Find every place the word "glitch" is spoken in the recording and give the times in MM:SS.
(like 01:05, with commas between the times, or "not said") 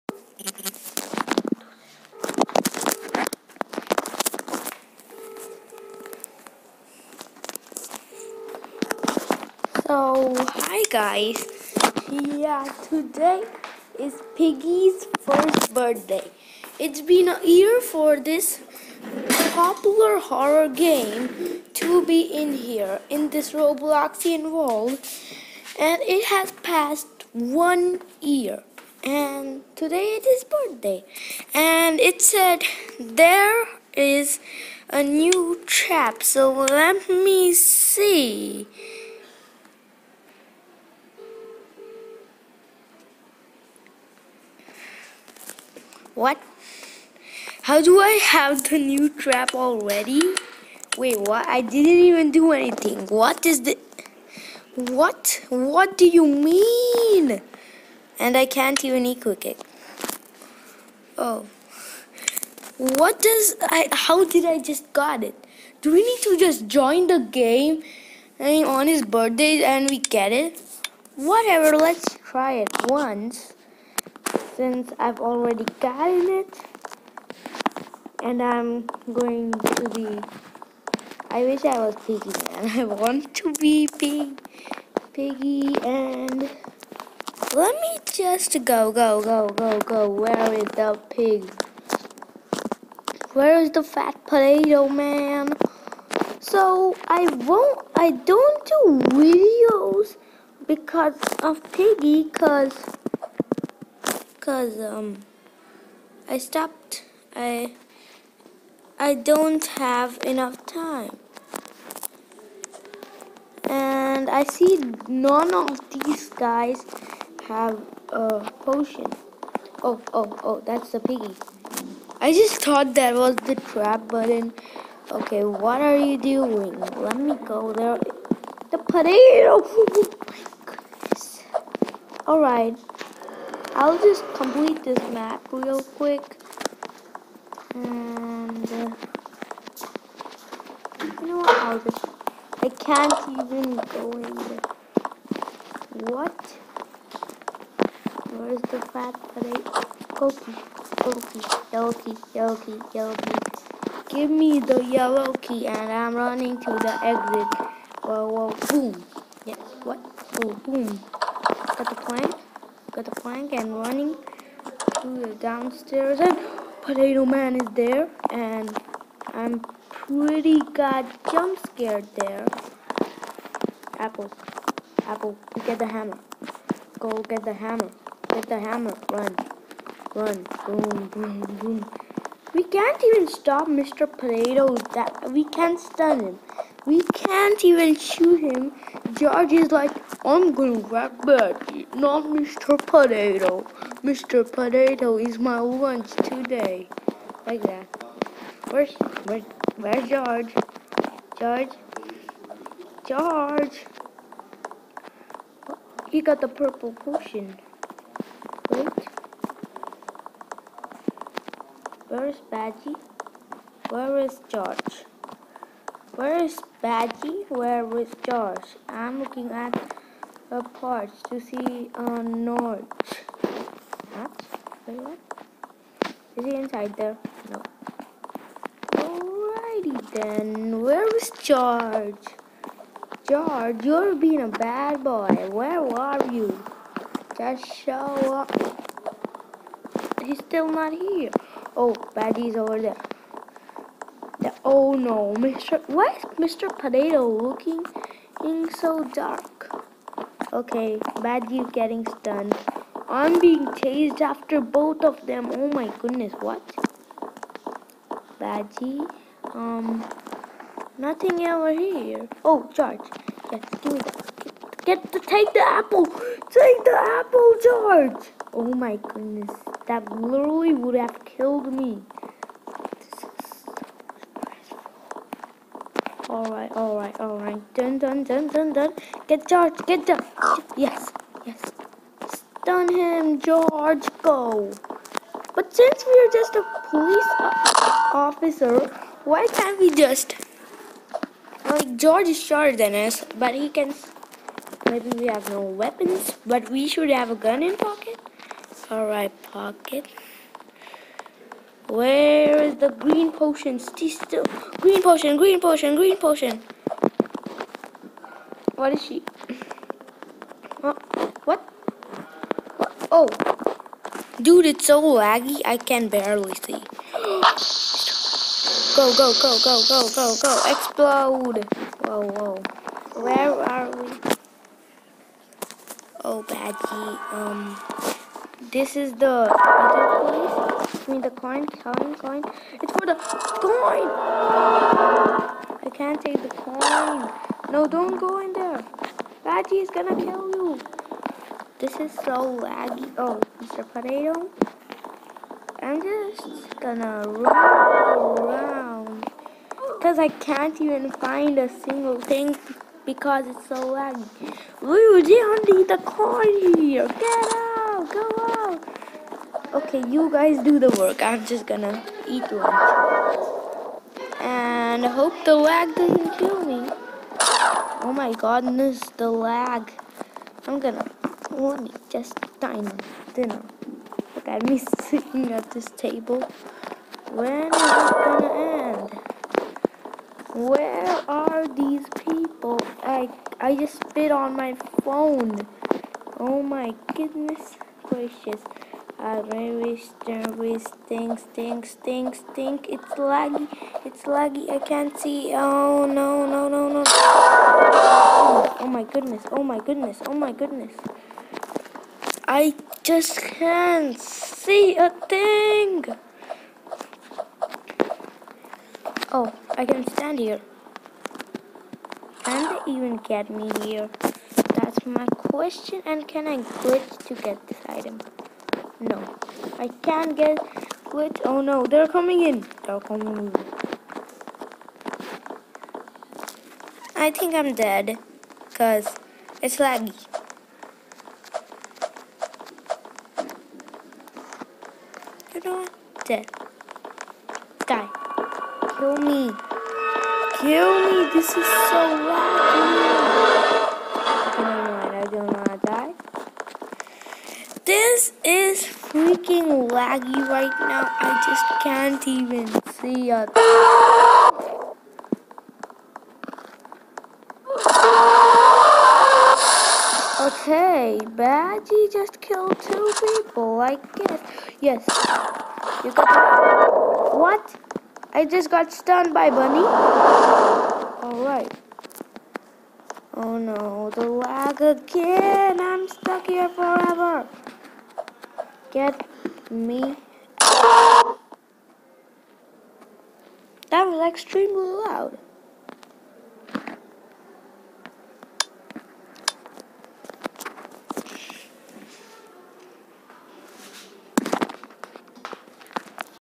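06:56, 07:01.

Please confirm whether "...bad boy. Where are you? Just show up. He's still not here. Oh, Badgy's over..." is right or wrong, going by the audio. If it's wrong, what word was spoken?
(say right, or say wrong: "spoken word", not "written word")
right.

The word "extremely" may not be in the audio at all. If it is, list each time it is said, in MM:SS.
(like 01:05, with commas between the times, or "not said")
08:04.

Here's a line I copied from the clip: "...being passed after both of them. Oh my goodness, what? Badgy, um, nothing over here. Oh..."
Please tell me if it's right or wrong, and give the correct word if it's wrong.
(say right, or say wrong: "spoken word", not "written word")
wrong: "chased", not "passed".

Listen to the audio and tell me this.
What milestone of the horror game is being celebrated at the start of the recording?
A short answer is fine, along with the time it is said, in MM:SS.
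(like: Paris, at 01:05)
first birthday, at 00:15.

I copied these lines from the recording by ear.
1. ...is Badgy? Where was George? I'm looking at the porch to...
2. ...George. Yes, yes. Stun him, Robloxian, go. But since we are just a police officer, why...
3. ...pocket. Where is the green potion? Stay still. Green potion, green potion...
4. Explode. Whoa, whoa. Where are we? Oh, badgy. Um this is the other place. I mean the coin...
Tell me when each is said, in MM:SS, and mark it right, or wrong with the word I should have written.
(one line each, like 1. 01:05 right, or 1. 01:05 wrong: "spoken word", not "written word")
1. 03:36 right
2. 04:40 wrong: "George", not "Robloxian"
3. 04:59 right
4. 05:20 right.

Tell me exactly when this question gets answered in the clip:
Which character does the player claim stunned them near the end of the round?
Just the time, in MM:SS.
07:49.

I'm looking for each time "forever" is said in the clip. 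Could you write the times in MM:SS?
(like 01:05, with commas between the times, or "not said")
07:56.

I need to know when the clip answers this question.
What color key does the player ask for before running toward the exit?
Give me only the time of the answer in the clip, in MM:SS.
02:34.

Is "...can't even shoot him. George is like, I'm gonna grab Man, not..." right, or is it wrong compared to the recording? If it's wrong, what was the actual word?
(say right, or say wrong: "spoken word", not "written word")
wrong: "Betty", not "Man".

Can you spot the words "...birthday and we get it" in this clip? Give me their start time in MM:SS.
01:09.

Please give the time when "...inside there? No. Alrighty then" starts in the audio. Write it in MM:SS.
03:46.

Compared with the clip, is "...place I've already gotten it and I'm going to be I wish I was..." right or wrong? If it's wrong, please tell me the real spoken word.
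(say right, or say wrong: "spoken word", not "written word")
wrong: "since", not "place".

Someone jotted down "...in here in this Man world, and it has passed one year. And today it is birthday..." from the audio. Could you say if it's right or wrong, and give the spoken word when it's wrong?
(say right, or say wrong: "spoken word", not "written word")
wrong: "Robloxian", not "Man".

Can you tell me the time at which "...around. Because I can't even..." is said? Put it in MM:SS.
05:48.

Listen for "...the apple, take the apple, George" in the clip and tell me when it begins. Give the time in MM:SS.
04:25.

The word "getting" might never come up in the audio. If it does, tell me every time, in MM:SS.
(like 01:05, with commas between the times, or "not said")
04:11.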